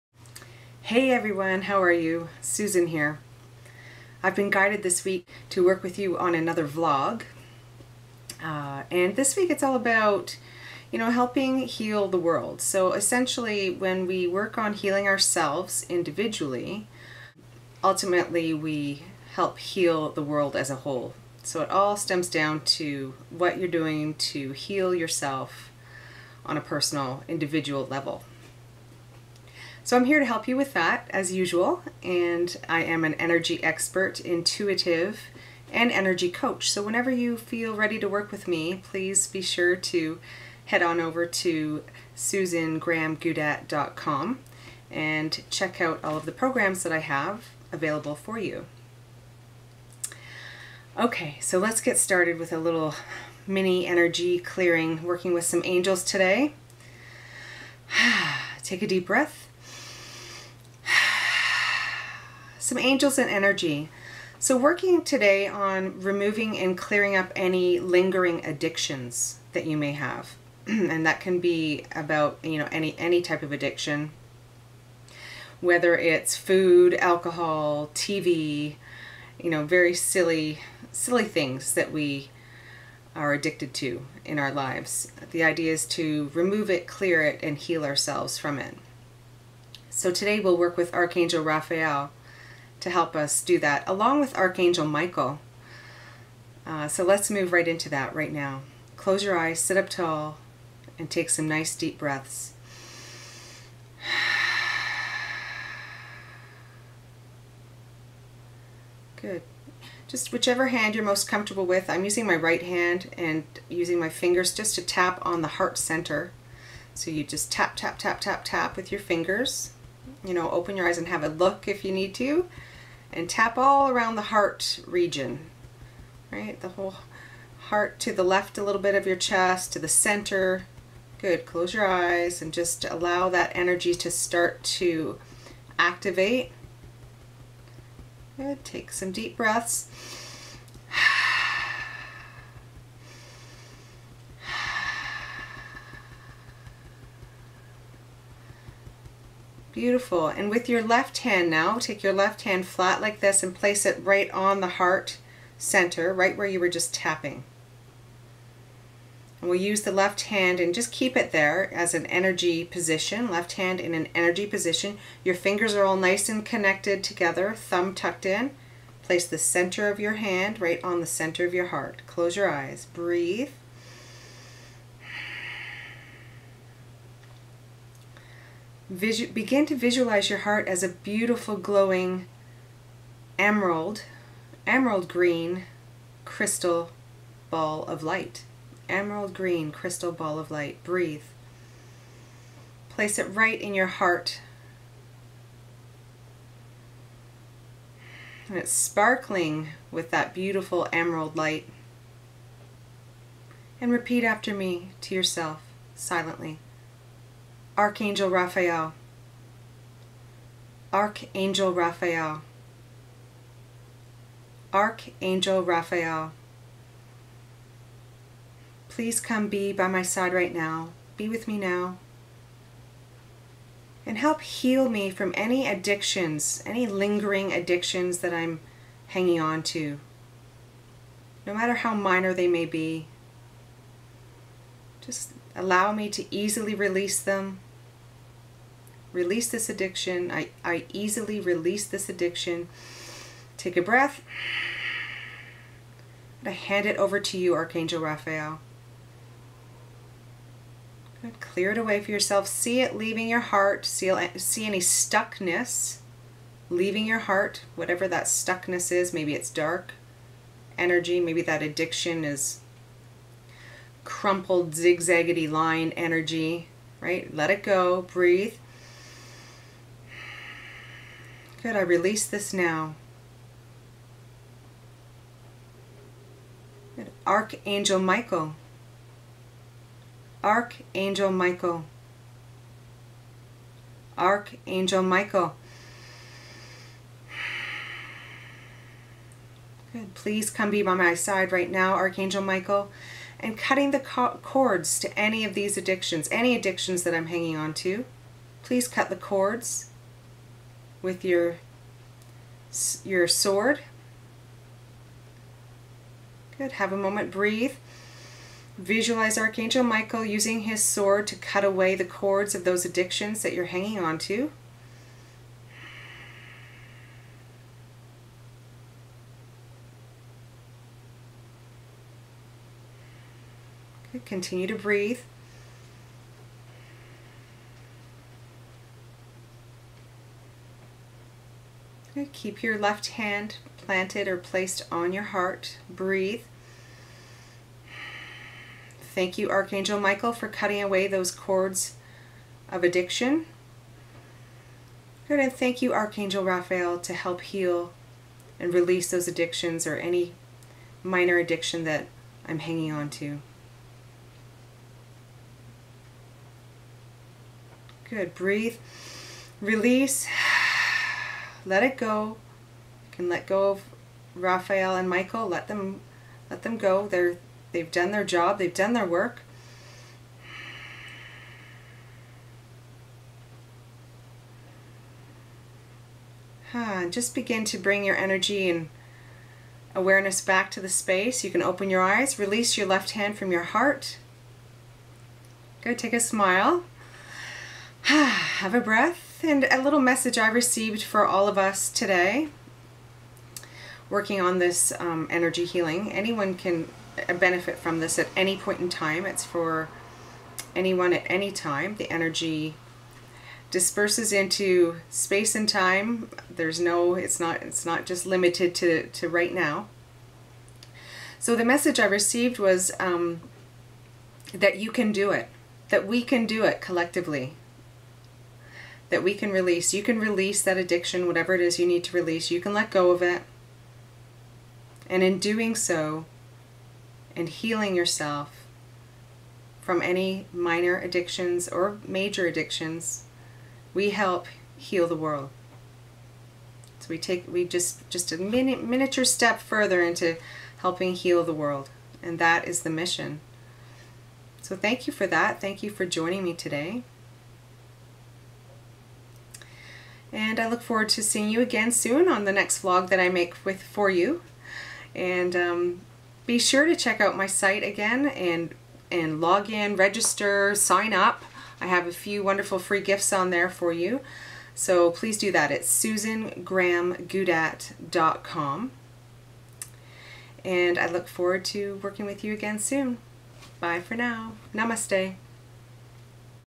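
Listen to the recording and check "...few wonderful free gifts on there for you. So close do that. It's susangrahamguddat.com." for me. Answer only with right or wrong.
wrong.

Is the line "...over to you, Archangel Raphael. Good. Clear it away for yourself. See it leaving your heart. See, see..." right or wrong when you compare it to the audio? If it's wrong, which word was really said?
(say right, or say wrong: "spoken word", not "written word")
right.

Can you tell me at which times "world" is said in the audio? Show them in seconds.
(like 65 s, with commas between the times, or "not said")
12 s, 20 s, 435 s, 441 s.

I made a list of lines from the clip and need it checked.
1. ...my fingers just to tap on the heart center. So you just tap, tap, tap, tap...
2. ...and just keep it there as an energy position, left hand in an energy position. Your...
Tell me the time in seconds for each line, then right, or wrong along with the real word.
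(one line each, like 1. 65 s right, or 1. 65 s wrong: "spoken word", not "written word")
1. 113 s right
2. 160 s right.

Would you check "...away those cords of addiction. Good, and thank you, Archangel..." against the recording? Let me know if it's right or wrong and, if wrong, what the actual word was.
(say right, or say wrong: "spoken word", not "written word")
right.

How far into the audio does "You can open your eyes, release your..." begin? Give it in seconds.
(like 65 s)
381 s.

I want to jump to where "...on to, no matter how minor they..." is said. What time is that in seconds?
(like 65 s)
229 s.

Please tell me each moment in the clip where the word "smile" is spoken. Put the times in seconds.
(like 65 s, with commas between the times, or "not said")
386 s.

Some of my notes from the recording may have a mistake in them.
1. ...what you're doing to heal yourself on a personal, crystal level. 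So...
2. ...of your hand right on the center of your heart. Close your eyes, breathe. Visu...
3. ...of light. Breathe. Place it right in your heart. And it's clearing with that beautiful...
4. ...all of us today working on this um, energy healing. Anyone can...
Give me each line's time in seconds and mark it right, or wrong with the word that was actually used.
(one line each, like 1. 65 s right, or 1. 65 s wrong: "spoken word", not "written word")
1. 23 s wrong: "individual", not "crystal"
2. 169 s right
3. 190 s wrong: "sparkling", not "clearing"
4. 391 s right.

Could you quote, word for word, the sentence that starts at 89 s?
So today we'll work with Archangel Raphael to help us do that, along with Archangel Michael.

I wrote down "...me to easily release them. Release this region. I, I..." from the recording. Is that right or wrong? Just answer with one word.
wrong.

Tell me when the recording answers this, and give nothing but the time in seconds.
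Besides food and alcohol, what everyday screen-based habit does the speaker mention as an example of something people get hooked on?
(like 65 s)
77 s.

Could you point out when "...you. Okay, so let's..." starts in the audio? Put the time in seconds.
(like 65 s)
48 s.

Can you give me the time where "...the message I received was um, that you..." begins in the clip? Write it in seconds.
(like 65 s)
411 s.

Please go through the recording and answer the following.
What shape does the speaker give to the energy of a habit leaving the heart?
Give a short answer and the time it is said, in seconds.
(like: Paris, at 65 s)
crumpled zigzaggedy line, at 264 s.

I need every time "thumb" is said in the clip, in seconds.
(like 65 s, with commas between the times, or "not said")
167 s.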